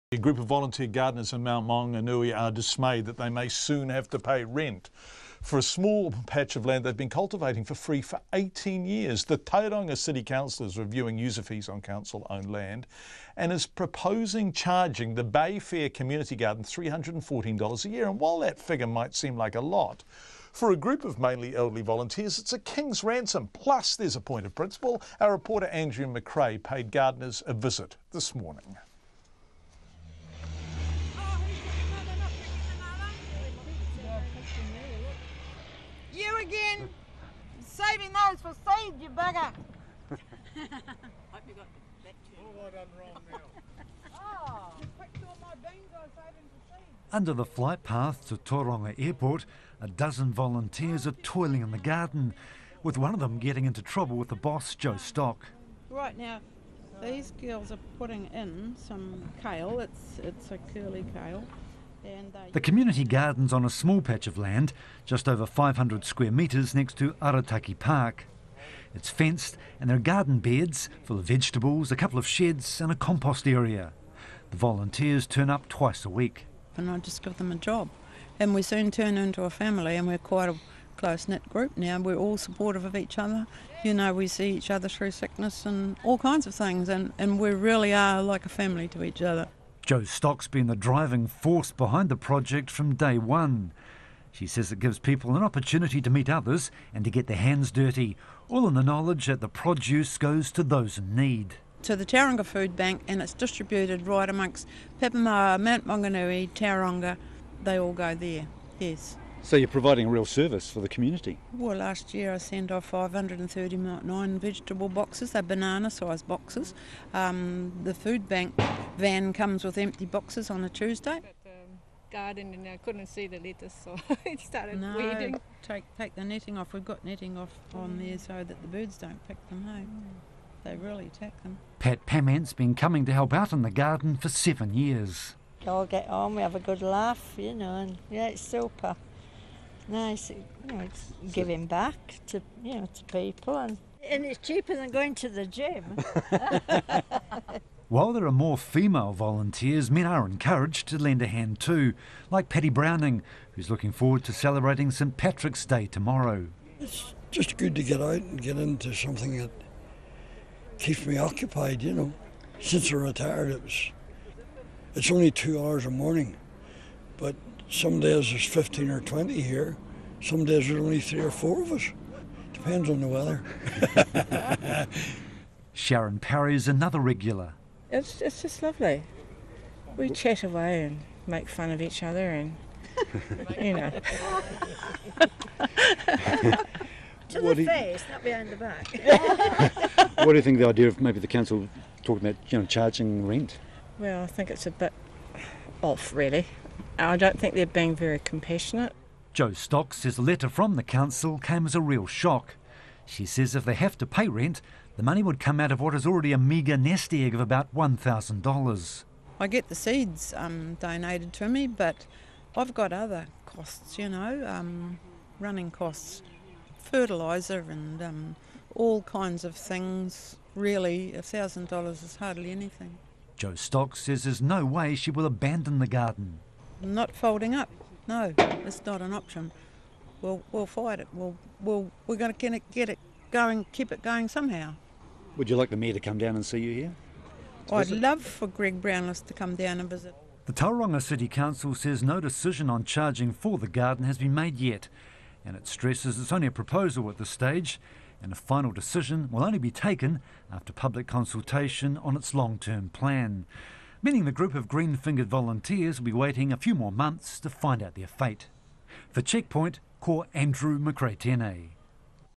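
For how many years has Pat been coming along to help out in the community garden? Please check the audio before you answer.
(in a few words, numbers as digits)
7.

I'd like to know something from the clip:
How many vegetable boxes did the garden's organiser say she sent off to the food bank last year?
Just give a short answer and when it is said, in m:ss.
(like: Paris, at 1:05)
539, at 1:52.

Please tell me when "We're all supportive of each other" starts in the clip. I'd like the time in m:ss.
1:21.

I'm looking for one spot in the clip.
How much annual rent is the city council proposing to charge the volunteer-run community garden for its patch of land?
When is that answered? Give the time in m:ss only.
0:16.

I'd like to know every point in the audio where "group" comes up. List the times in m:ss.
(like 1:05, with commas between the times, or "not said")
0:00, 0:20, 1:21, 4:14.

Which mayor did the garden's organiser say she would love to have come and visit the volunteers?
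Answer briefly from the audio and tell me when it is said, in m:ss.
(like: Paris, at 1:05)
Greg Brownless, at 3:58.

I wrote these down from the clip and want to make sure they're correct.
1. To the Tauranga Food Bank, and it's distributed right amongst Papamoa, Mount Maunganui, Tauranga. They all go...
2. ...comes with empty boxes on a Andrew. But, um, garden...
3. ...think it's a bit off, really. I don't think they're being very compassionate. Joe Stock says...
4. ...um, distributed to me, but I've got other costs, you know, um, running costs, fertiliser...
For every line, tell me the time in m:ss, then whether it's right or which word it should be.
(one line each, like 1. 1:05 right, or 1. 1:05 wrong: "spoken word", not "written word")
1. 1:41 right
2. 1:59 wrong: "Tuesday", not "Andrew"
3. 3:14 right
4. 3:30 wrong: "donated", not "distributed".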